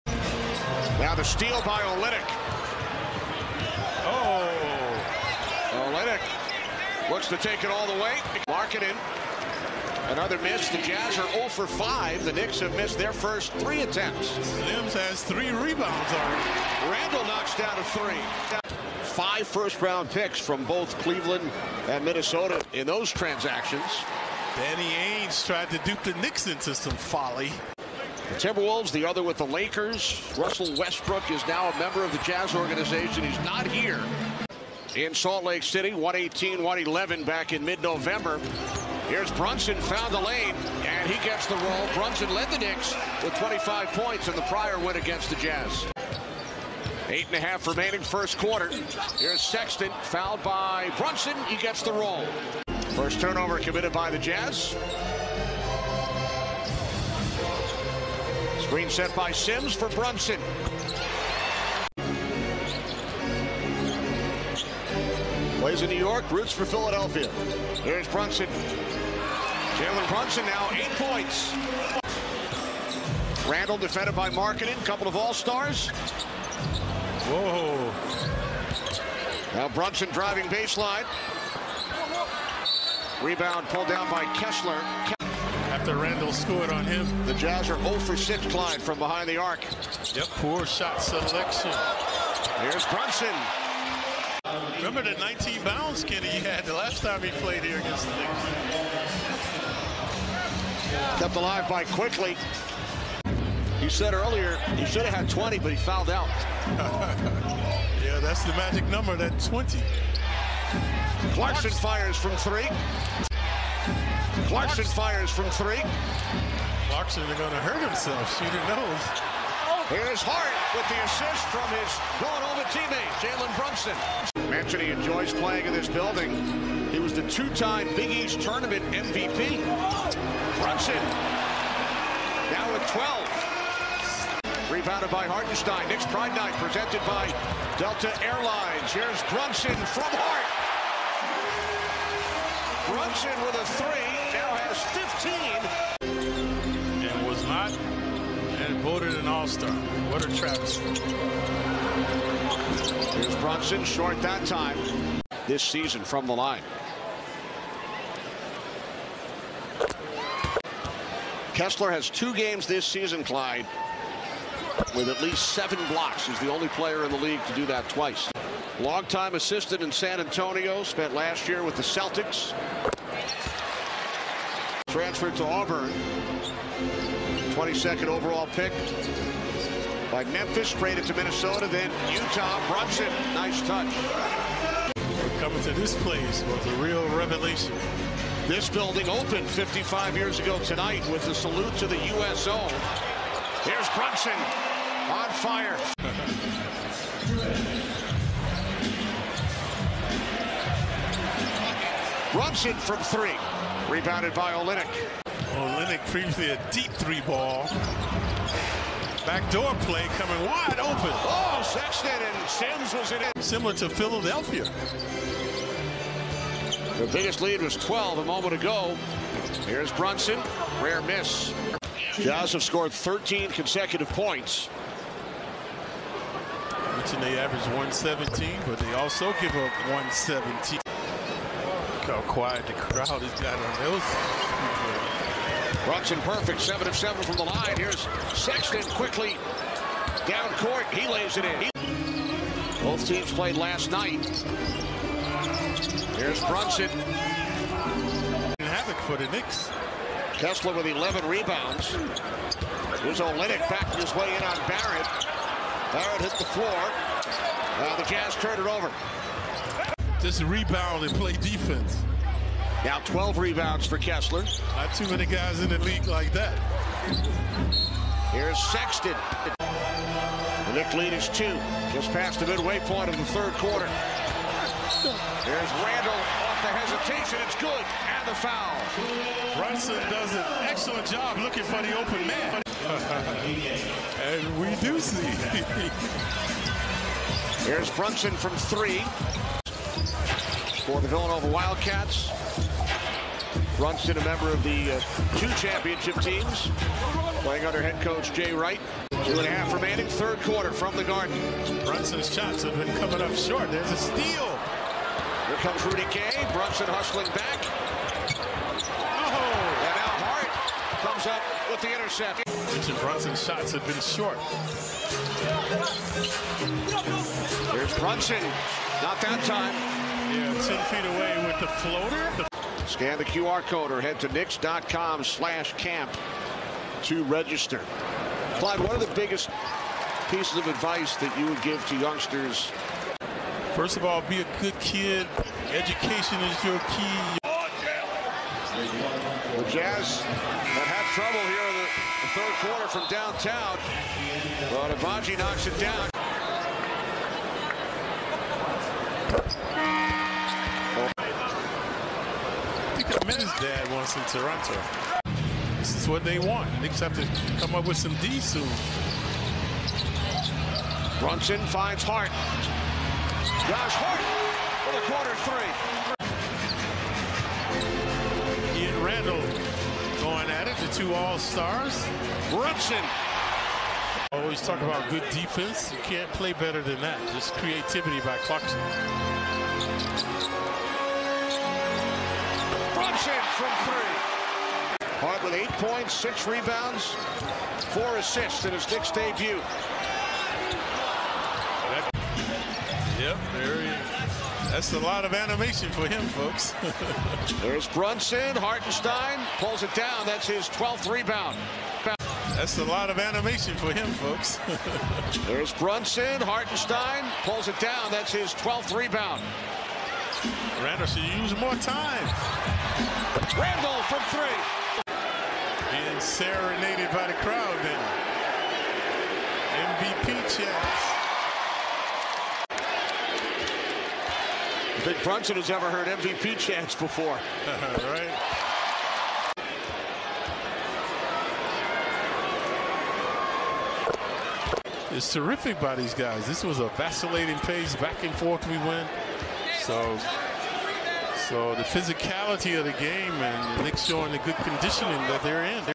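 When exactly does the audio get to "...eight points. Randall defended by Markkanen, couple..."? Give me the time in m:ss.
1:10.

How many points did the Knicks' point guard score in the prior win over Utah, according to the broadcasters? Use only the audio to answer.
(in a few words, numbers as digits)
25.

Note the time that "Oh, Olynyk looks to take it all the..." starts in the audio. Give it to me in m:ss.
0:04.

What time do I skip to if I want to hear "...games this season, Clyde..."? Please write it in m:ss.
2:42.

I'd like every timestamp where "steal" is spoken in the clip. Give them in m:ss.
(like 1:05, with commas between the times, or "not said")
0:01, 5:03.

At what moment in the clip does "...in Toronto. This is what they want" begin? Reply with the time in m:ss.
5:54.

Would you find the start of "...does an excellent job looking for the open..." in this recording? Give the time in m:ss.
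4:40.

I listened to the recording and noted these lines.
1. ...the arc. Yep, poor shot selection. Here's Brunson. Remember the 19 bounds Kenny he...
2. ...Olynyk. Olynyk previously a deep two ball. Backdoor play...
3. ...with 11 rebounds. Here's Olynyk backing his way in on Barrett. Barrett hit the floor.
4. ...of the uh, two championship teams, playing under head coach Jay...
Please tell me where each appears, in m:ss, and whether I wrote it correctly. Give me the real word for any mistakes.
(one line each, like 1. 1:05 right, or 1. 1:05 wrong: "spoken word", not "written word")
1. 1:29 right
2. 3:24 wrong: "three", not "two"
3. 4:10 right
4. 4:54 right.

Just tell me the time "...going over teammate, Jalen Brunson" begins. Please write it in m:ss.
2:02.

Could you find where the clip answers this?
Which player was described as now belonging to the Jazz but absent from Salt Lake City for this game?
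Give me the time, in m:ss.
0:30.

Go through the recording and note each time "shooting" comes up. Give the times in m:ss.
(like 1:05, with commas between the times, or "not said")
1:58.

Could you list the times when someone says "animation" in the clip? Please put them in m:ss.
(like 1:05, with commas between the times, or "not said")
6:35, 6:43.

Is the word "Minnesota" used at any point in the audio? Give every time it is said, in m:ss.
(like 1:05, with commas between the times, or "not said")
0:22, 3:01.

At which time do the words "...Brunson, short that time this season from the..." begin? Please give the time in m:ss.
2:33.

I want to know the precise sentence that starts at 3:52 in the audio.
Look how quiet the crowd has got on those.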